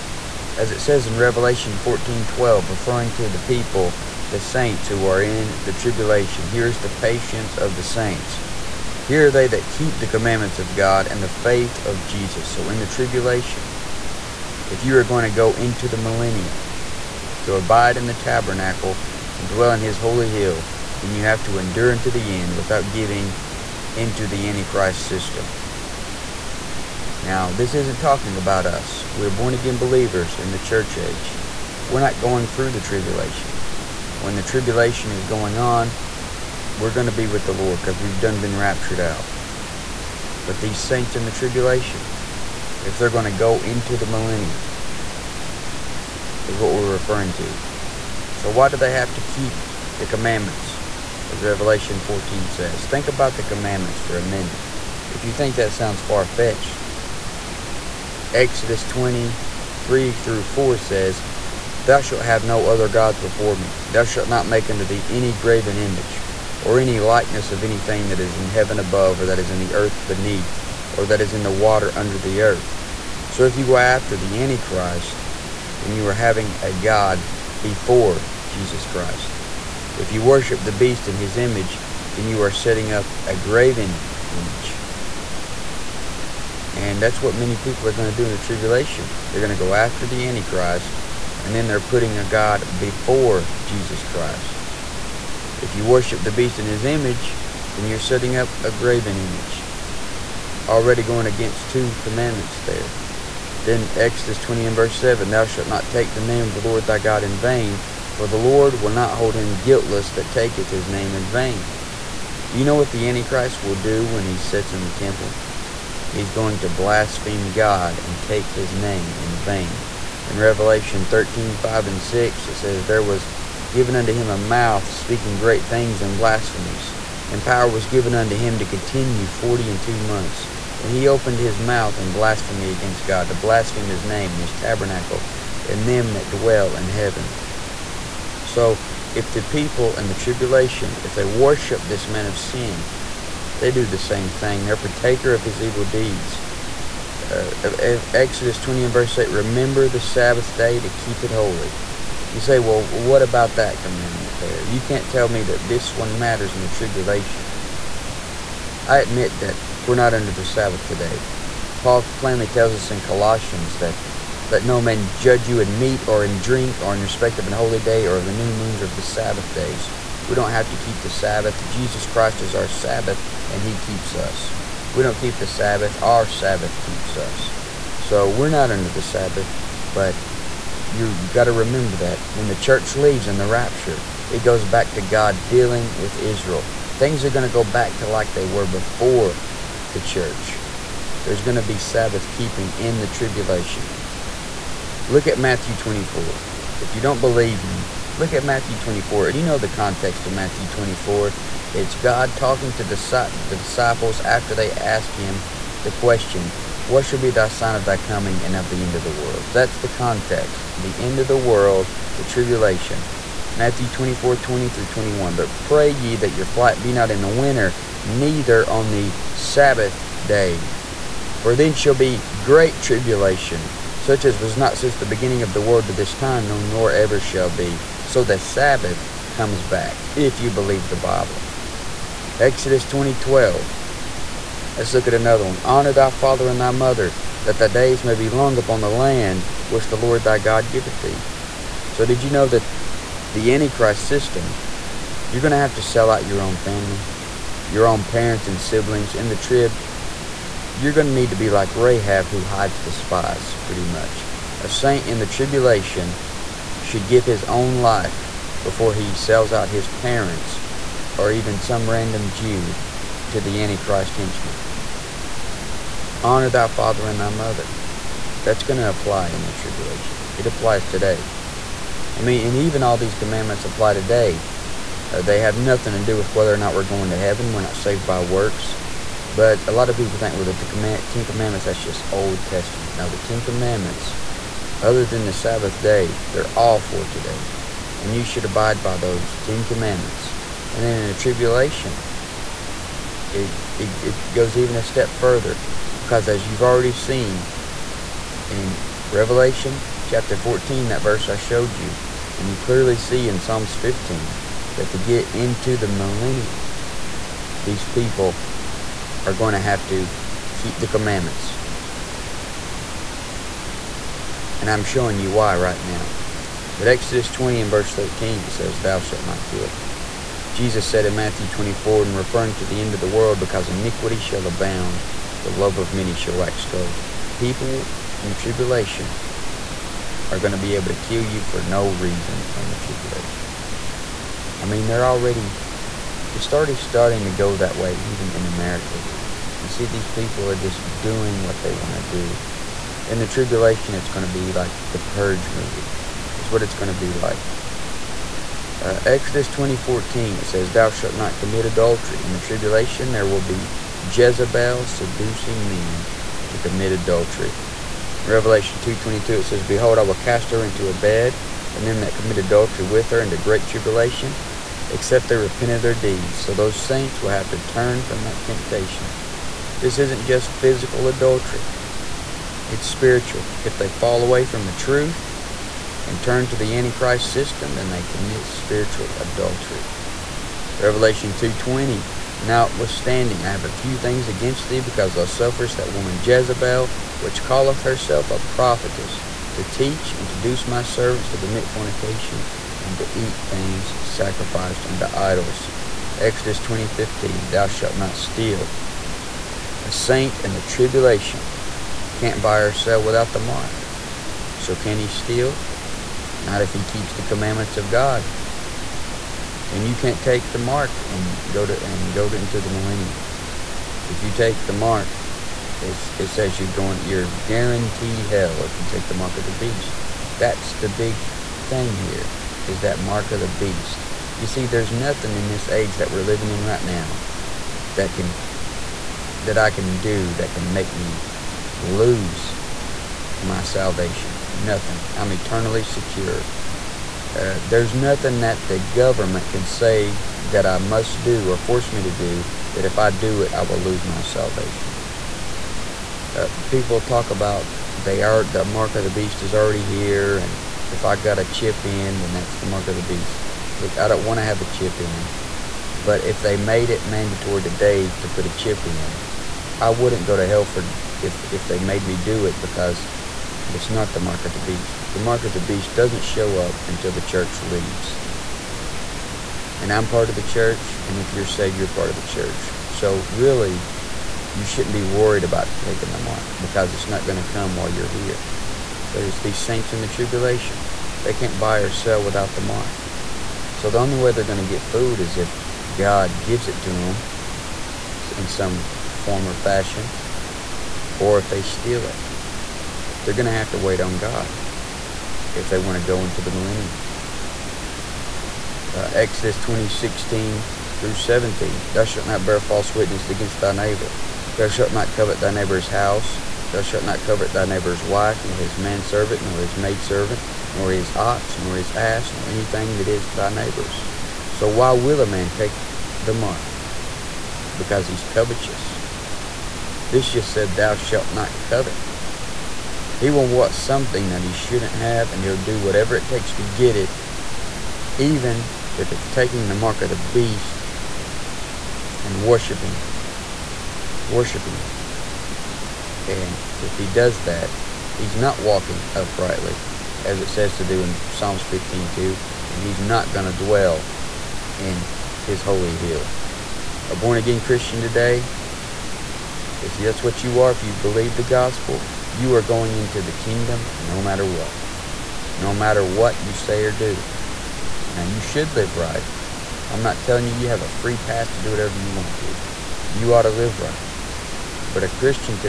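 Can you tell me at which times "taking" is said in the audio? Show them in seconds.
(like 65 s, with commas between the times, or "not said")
475 s, 529 s.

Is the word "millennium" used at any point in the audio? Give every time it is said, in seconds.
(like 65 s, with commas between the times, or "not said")
15 s, 44 s, 305 s, 412 s, 496 s.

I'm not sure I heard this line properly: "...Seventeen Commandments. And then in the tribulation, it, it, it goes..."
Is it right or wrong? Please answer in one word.
wrong.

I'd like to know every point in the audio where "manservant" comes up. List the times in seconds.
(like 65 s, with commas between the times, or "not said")
508 s.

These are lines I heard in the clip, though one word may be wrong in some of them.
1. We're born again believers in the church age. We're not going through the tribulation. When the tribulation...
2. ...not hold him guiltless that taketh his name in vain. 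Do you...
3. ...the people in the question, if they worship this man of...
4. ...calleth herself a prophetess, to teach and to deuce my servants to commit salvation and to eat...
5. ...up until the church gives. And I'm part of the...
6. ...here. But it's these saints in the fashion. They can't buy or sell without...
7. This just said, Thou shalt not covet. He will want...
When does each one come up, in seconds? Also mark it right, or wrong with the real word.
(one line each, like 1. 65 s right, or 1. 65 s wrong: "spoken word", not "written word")
1. 29 s right
2. 108 s right
3. 139 s wrong: "tribulation", not "question"
4. 387 s wrong: "fornication", not "salvation"
5. 466 s wrong: "leaves", not "gives"
6. 478 s wrong: "tribulation", not "fashion"
7. 520 s right.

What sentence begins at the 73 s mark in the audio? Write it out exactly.
So if you go after the Antichrist, then you are having a God before Jesus Christ.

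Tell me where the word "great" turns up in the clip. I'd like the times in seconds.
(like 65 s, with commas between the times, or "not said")
125 s, 222 s, 363 s.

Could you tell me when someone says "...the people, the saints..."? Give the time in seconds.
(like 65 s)
3 s.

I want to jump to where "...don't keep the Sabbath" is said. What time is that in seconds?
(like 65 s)
175 s.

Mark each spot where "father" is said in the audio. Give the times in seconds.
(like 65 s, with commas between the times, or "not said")
236 s, 266 s.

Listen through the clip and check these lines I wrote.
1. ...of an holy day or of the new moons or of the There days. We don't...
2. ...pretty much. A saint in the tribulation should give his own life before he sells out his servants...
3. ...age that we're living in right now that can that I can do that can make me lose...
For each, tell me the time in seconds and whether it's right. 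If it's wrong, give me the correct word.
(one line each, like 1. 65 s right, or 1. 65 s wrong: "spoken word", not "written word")
1. 167 s wrong: "Sabbath", not "There"
2. 253 s wrong: "parents", not "servants"
3. 425 s right.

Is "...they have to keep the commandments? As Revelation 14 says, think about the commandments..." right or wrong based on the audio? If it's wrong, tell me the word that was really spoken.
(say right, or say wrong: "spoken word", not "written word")
right.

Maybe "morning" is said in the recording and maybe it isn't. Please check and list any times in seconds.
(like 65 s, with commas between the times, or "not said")
not said.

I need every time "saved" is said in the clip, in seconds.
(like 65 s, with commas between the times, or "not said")
277 s, 471 s.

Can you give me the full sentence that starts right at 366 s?
So those saints will have to turn from that temptation.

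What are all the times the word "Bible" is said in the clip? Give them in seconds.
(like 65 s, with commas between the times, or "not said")
230 s.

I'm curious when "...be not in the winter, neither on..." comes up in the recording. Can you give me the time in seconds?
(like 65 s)
216 s.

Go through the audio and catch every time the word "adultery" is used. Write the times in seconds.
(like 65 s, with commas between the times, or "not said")
351 s, 356 s, 362 s, 371 s, 379 s.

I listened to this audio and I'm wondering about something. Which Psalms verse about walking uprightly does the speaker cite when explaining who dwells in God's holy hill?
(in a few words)
Psalms 15:2.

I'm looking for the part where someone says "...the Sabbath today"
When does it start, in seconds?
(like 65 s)
160 s.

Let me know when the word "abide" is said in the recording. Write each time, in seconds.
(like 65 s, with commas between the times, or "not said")
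17 s, 288 s.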